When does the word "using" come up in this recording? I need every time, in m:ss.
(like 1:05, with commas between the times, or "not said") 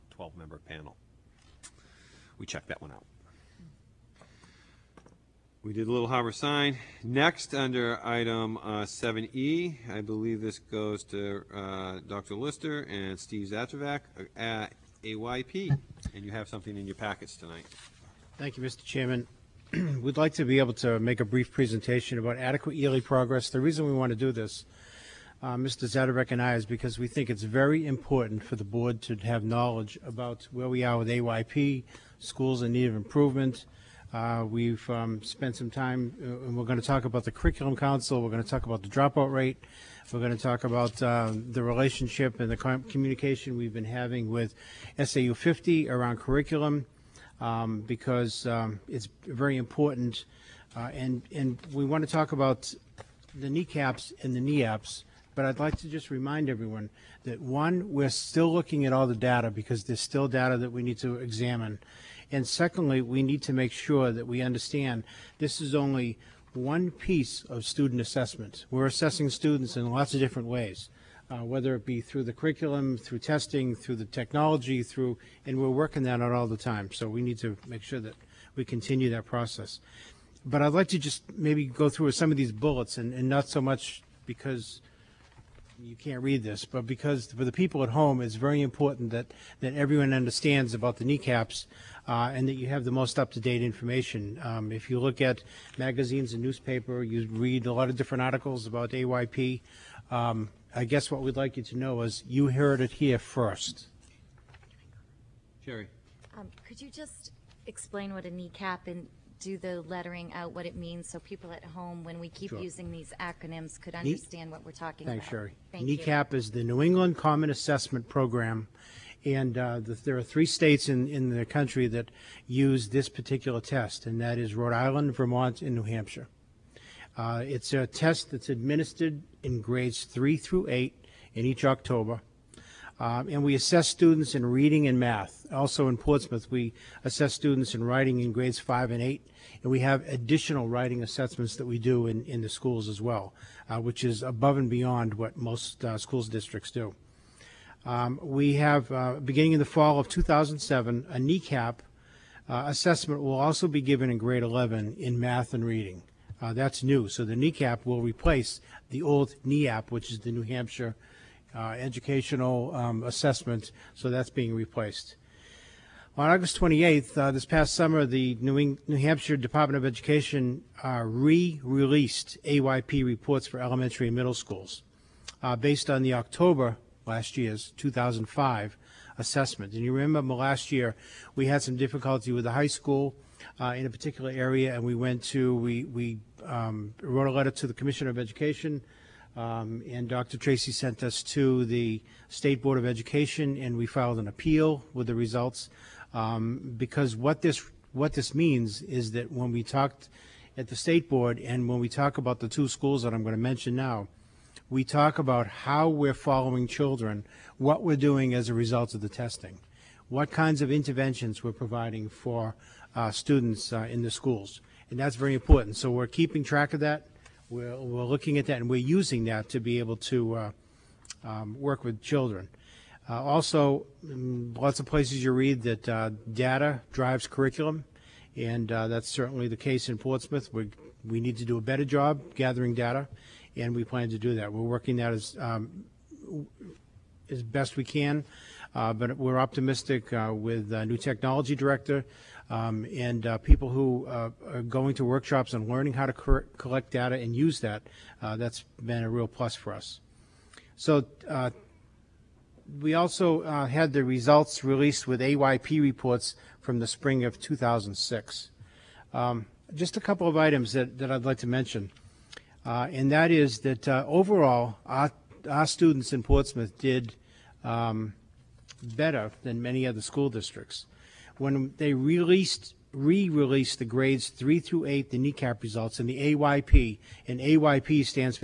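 1:52, 3:38.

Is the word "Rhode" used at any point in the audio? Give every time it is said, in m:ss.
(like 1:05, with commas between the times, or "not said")
2:04.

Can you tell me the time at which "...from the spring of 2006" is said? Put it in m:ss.
4:16.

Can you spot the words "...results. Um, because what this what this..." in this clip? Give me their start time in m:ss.
3:15.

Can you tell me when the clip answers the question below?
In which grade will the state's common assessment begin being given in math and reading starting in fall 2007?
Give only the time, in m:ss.
2:34.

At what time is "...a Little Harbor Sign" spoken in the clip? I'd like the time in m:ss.
0:05.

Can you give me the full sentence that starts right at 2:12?
Um, and we assess students in reading and math.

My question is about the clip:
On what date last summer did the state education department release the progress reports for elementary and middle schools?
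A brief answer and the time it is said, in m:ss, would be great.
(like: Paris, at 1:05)
August 28th, at 2:46.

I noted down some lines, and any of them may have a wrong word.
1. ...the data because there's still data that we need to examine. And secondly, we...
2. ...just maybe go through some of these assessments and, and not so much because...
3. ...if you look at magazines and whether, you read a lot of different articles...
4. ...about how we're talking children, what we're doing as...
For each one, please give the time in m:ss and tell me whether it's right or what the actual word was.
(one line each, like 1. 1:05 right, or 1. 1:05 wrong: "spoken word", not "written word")
1. 0:59 right
2. 1:20 wrong: "bullets", not "assessments"
3. 1:34 wrong: "newspaper", not "whether"
4. 3:25 wrong: "following", not "talking".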